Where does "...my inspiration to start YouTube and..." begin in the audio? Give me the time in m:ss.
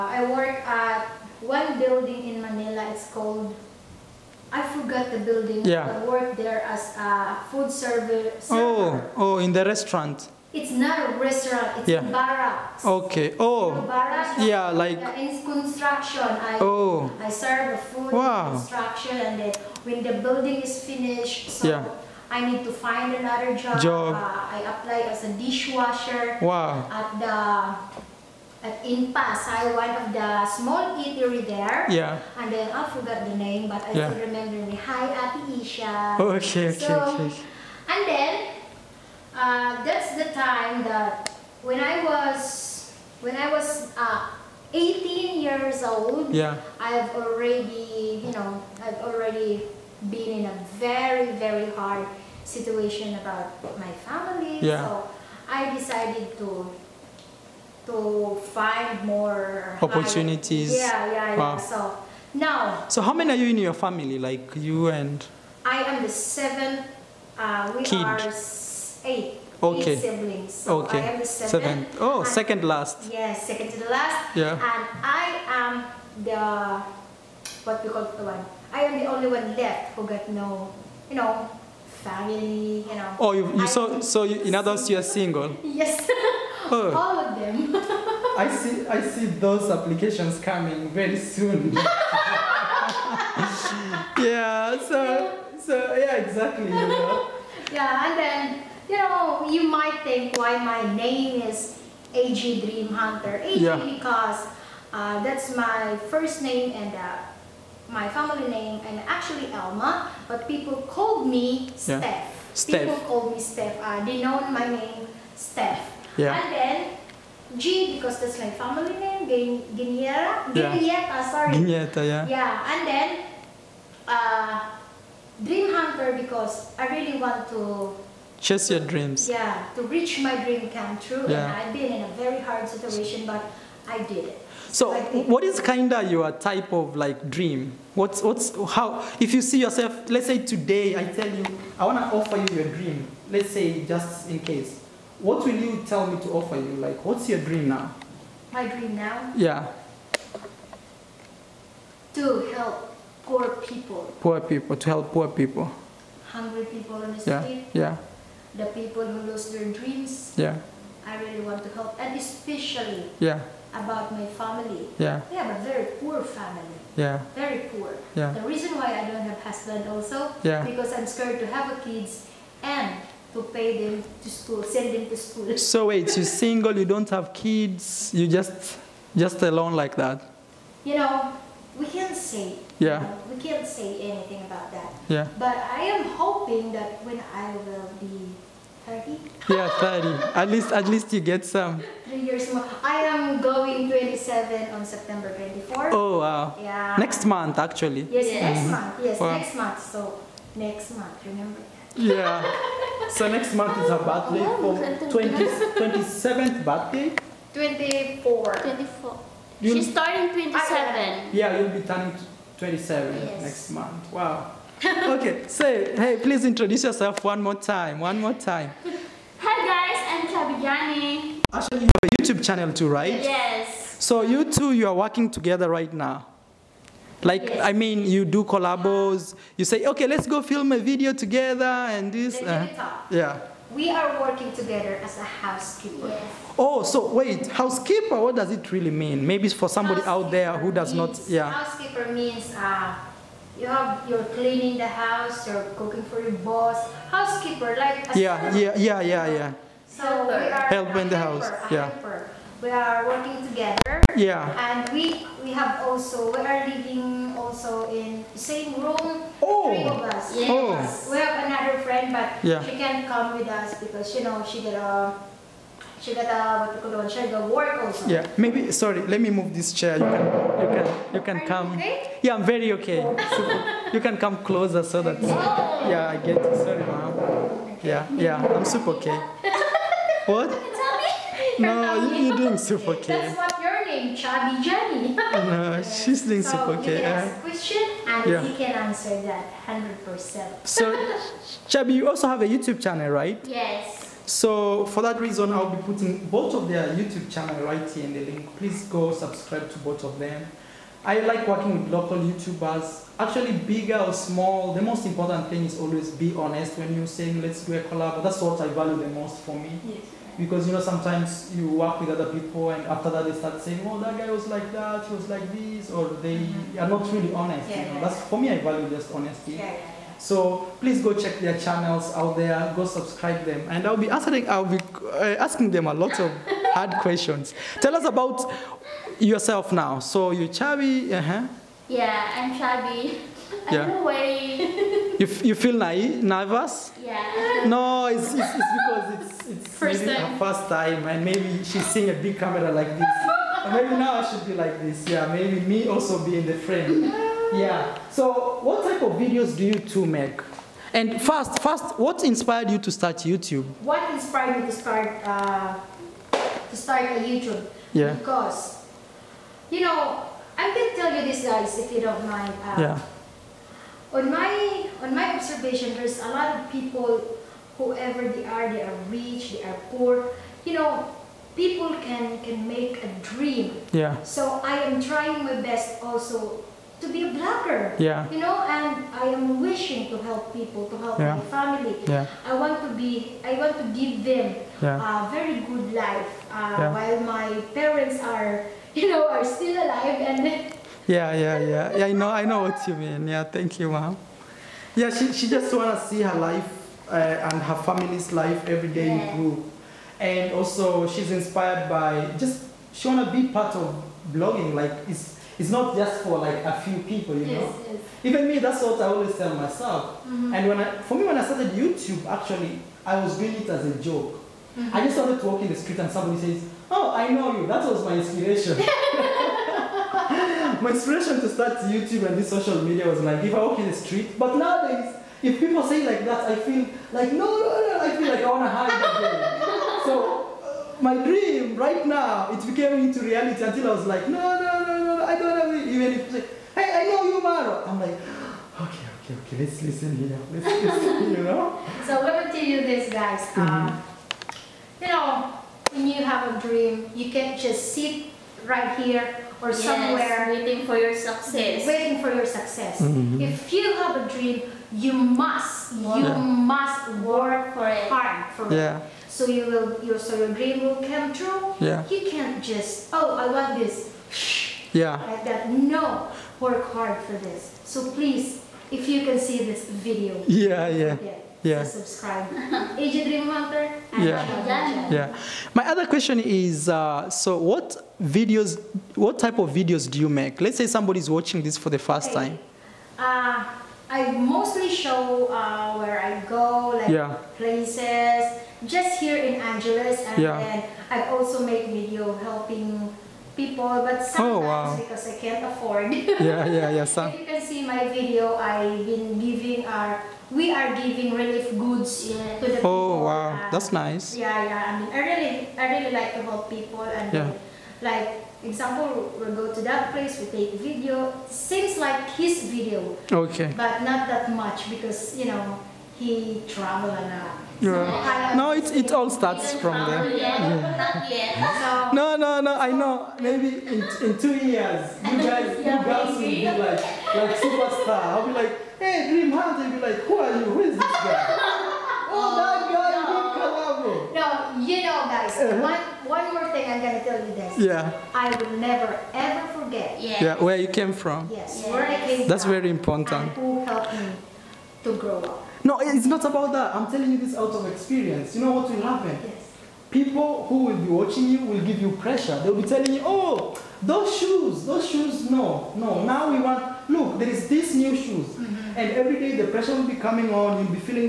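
7:00.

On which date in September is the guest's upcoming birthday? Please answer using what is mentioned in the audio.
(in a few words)
September 24.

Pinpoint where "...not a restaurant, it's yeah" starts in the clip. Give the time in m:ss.
0:10.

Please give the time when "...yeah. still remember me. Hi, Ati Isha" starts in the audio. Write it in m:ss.
0:33.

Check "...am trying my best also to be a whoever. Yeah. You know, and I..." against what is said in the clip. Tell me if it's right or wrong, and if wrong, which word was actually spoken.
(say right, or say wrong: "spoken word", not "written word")
wrong: "blogger", not "whoever".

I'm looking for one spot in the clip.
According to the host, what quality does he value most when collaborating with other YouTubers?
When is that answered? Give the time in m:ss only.
5:19.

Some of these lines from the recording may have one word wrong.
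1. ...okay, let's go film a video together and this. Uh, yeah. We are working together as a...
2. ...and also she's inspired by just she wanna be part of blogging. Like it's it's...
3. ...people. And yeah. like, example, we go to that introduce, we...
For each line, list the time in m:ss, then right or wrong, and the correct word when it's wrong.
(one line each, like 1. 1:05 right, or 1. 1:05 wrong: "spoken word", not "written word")
1. 3:49 right
2. 6:40 right
3. 8:26 wrong: "place", not "introduce".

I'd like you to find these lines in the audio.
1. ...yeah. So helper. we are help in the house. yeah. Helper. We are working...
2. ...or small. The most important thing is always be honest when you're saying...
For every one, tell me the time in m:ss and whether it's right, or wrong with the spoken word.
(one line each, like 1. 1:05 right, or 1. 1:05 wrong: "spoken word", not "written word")
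1. 4:09 right
2. 5:03 right.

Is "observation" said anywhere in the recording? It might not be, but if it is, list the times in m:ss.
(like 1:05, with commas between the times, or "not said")
6:05.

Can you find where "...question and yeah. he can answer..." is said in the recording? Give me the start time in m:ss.
4:47.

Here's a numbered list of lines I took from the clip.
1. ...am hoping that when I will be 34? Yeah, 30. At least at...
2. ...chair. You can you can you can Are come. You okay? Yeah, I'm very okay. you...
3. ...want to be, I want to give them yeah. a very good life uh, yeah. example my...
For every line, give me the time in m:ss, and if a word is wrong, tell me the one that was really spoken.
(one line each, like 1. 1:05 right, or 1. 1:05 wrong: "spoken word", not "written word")
1. 3:05 wrong: "30", not "34"
2. 4:29 right
3. 6:22 wrong: "while", not "example".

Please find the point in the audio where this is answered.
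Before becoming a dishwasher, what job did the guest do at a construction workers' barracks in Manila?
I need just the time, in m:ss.
0:07.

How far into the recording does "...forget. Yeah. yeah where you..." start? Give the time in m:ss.
8:59.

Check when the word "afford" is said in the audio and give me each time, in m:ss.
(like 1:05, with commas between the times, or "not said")
8:15.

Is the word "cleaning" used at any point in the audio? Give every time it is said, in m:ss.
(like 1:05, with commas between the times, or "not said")
4:04.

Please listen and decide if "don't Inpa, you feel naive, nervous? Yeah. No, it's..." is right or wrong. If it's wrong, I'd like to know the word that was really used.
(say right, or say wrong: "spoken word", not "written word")
wrong: "You", not "Inpa".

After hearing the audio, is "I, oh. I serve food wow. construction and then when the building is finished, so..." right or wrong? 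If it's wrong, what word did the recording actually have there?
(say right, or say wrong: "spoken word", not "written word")
right.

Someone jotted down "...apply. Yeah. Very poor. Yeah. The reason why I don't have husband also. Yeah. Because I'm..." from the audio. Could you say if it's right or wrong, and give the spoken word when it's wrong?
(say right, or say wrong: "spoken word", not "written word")
wrong: "family", not "apply".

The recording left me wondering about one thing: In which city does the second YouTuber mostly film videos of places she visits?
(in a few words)
Angeles.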